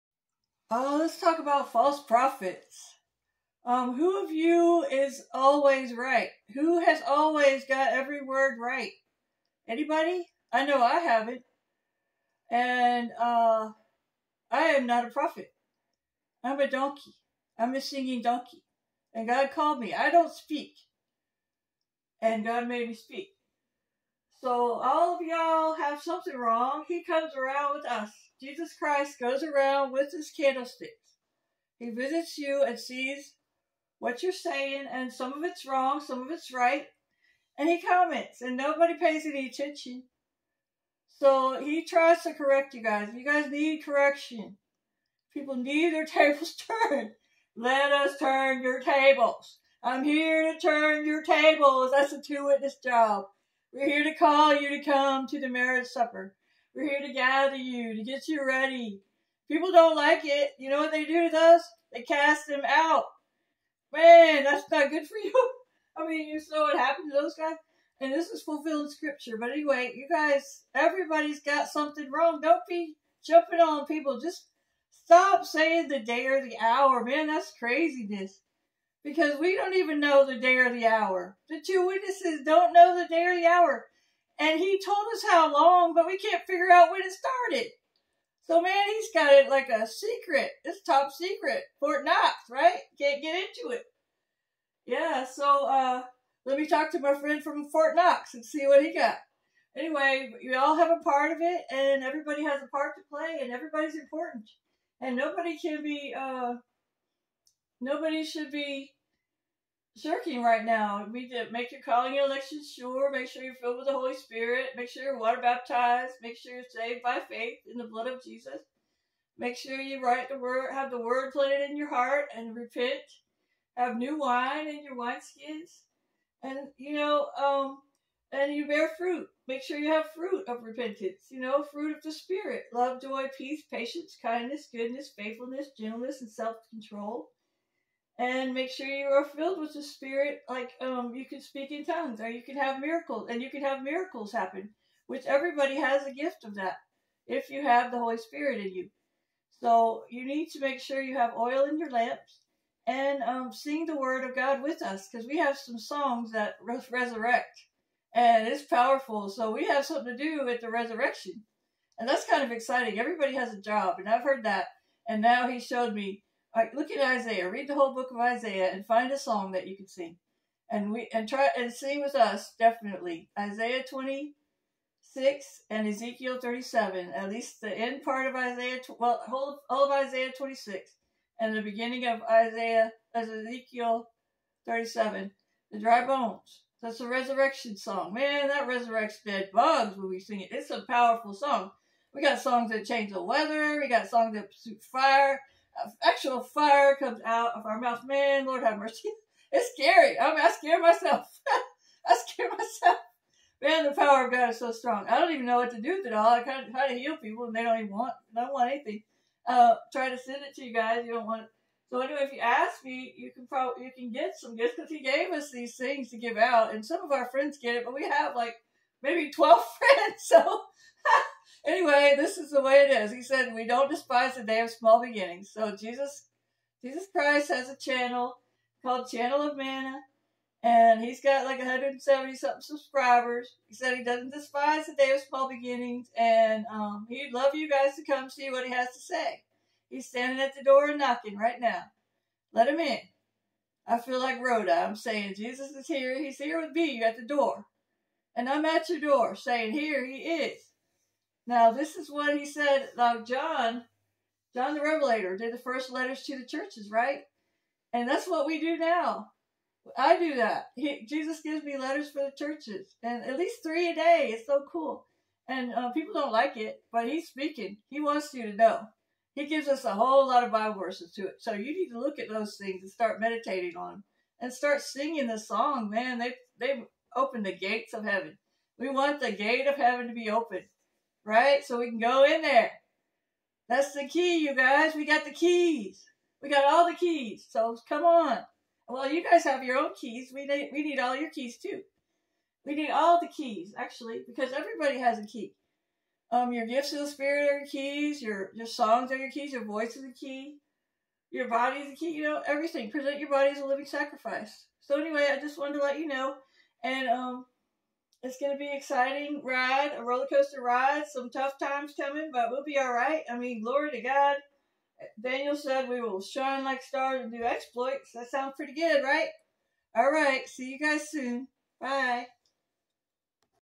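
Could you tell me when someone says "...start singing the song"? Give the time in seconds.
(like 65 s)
274 s.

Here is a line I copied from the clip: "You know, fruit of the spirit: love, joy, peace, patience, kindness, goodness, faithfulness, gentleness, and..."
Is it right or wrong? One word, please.
right.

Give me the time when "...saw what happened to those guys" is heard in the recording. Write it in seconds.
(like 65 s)
66 s.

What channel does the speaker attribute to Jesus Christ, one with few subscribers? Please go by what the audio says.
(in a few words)
Channel of Manna.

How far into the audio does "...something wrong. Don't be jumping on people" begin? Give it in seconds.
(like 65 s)
71 s.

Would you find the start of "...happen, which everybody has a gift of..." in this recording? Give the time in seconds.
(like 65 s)
144 s.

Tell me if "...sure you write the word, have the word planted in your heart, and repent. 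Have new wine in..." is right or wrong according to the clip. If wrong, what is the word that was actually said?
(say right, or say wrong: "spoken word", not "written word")
right.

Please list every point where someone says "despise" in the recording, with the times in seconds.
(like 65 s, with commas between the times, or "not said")
223 s, 234 s.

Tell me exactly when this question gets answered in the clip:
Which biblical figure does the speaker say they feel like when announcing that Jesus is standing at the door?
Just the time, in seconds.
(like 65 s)
244 s.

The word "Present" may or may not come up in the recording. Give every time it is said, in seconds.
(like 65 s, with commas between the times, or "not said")
302 s.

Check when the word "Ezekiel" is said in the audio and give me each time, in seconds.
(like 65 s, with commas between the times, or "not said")
175 s, 183 s.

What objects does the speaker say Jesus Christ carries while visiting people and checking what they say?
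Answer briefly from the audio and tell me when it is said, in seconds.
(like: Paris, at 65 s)
candlesticks, at 30 s.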